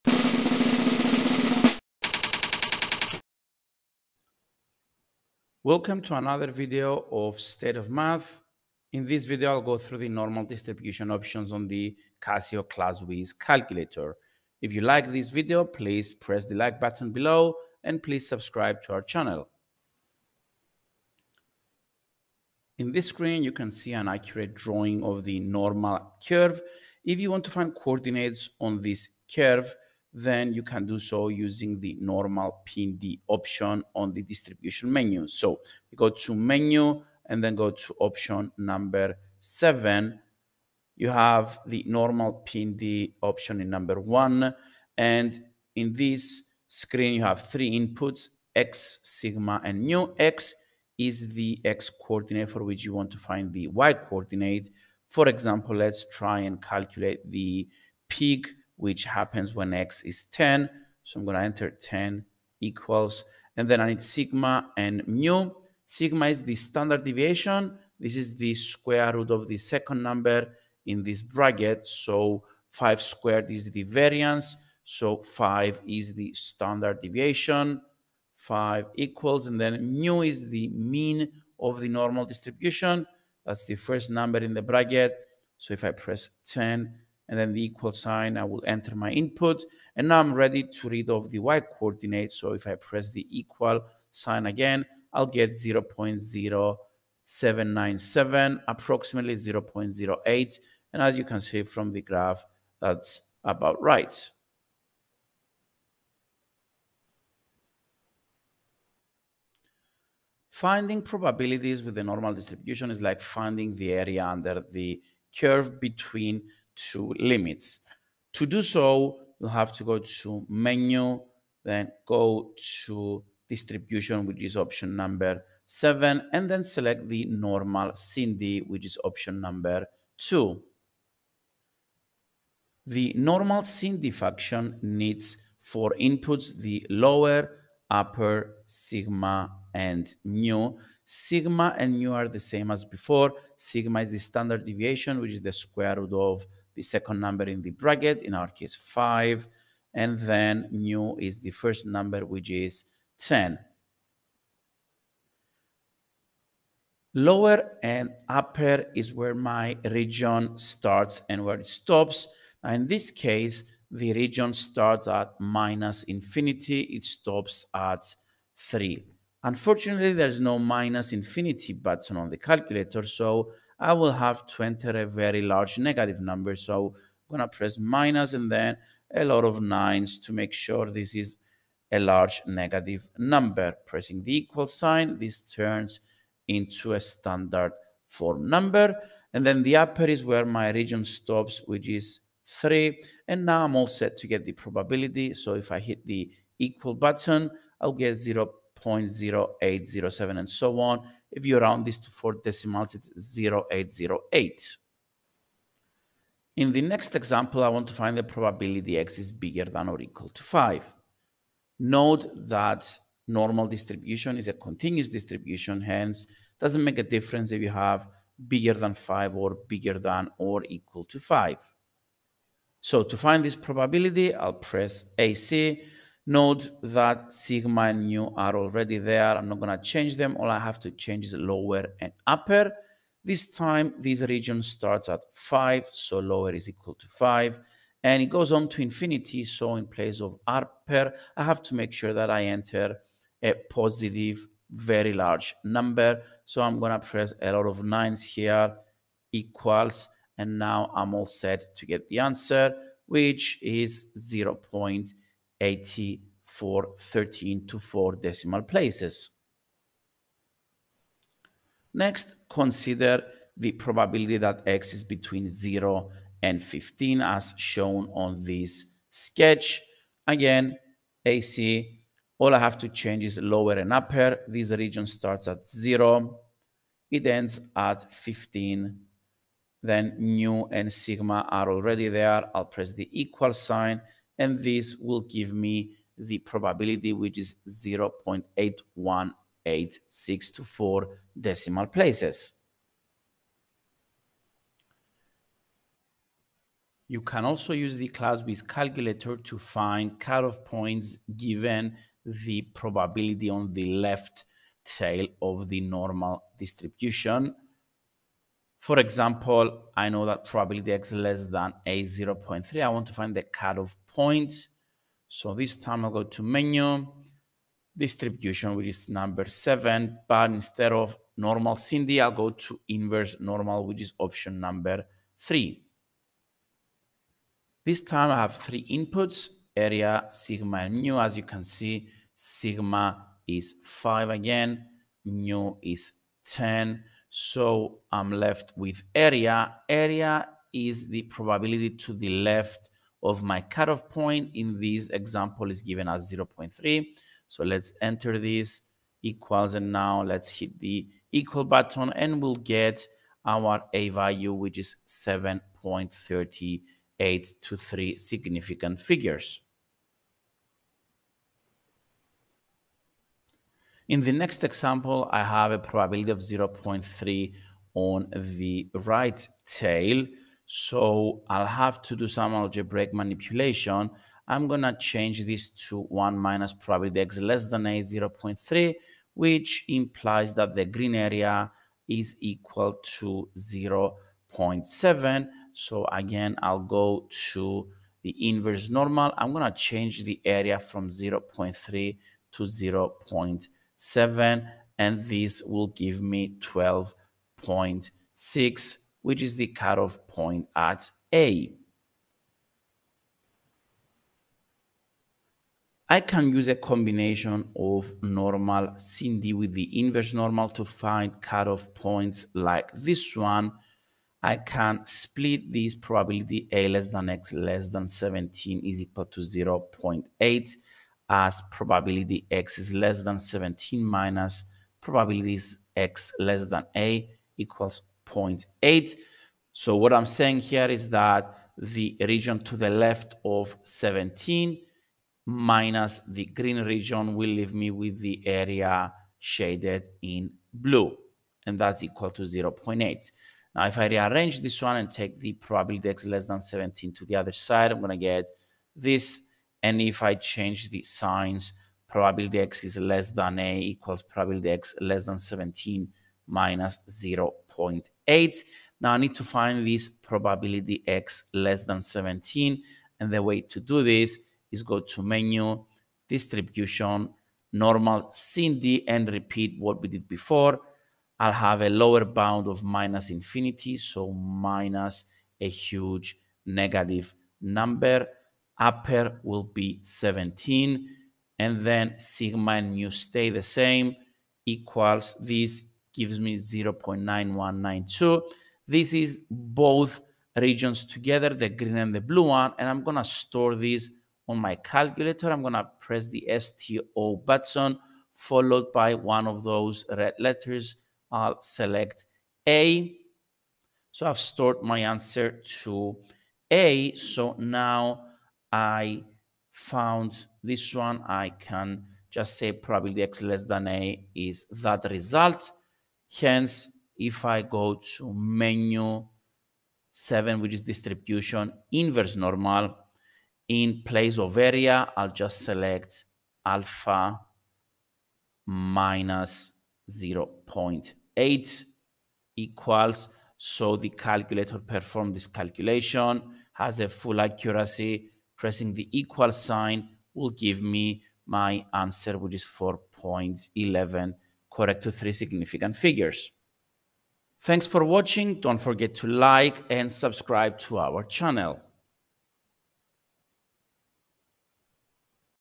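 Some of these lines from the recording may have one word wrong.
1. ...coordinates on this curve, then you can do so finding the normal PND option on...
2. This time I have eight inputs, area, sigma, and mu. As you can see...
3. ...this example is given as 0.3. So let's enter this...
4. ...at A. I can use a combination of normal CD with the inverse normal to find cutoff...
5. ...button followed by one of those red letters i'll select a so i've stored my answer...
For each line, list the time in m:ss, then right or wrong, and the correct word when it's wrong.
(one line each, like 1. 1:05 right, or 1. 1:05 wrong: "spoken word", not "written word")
1. 0:27 wrong: "using", not "finding"
2. 5:27 wrong: "three", not "eight"
3. 5:44 right
4. 6:40 right
5. 8:17 right.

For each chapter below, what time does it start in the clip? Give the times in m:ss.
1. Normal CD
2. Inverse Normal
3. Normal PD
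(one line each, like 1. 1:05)
1. 1:47
2. 4:55
3. 0:21.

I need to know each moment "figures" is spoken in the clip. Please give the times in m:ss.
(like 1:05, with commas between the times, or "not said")
5:58, 9:05.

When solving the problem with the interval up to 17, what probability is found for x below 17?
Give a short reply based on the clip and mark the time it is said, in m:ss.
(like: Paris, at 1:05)
0.9192, at 8:06.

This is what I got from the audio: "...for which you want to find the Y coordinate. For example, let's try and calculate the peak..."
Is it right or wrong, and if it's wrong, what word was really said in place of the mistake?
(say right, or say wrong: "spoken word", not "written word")
right.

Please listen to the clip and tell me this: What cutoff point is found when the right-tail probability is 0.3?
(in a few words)
12.6.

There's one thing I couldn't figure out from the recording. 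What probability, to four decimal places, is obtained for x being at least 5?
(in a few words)
0.8413.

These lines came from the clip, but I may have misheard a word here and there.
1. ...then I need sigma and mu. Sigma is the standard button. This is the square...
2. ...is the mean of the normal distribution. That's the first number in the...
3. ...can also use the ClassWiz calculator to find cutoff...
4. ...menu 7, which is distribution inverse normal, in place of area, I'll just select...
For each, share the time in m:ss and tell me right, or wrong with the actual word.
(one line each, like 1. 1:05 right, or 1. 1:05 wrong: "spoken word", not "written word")
1. 1:03 wrong: "deviation", not "button"
2. 1:20 right
3. 4:57 right
4. 8:38 right.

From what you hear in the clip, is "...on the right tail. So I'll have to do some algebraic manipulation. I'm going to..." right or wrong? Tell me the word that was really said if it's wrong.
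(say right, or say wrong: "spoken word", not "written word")
right.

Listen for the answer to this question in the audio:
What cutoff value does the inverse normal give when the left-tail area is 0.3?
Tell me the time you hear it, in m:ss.
5:55.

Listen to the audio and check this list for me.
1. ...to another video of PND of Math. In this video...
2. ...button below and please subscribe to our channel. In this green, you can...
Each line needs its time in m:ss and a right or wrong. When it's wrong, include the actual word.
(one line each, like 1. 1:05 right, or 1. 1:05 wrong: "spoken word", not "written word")
1. 0:06 wrong: "State", not "PND"
2. 0:16 wrong: "screen", not "green".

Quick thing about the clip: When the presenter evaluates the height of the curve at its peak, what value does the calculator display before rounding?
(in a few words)
0.0797.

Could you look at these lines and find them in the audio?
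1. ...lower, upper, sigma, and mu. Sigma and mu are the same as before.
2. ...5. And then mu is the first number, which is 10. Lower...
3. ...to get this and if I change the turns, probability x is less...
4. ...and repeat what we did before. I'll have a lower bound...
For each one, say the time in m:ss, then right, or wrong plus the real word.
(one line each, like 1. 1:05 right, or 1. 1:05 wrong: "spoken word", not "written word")
1. 2:16 right
2. 2:28 right
3. 7:28 wrong: "signs", not "turns"
4. 7:49 right.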